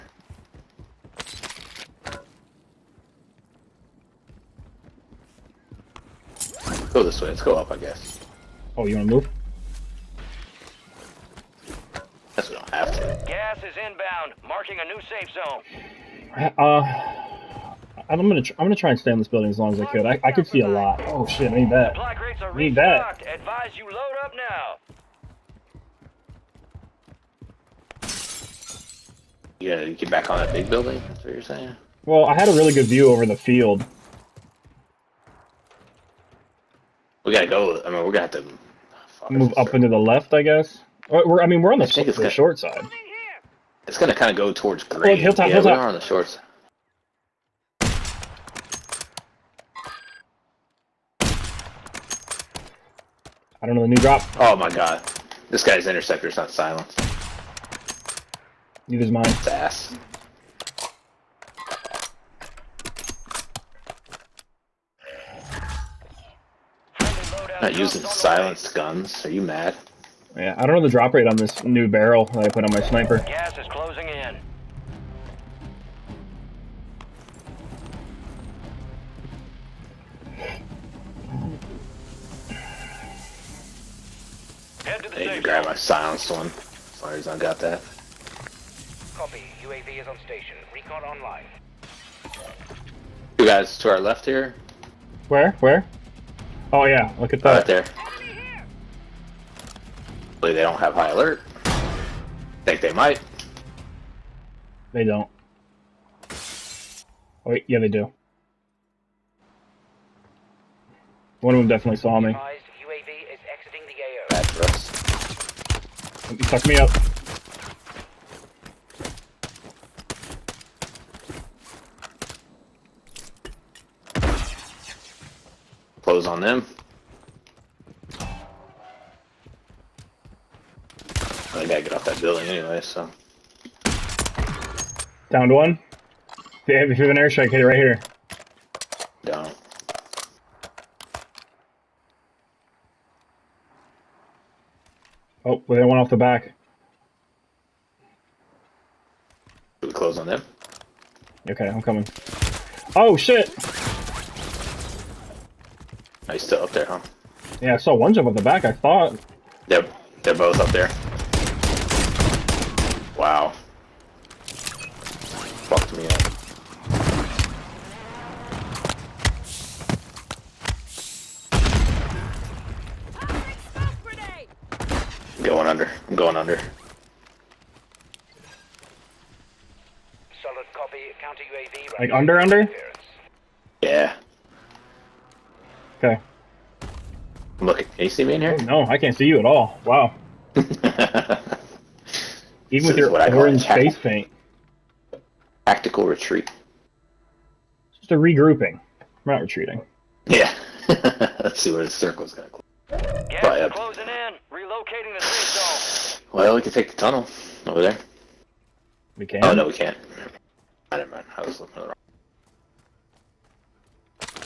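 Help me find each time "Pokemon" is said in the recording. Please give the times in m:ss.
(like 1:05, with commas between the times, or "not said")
not said.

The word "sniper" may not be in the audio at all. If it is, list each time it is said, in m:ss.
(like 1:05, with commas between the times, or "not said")
1:12.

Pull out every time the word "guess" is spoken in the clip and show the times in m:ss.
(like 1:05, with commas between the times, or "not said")
0:07, 0:12, 0:40.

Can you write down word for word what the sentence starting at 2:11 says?
I gotta get off that building anyway, so.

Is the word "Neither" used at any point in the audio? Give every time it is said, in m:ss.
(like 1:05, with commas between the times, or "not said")
0:58.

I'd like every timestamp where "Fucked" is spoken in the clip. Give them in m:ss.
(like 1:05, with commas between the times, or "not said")
2:45.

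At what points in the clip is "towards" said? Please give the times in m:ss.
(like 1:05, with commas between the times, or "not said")
0:44.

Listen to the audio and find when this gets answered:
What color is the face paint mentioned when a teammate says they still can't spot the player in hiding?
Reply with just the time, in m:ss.
3:13.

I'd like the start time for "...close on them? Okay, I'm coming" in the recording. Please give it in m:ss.
2:29.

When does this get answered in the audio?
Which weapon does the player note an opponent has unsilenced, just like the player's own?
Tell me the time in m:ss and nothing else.
0:55.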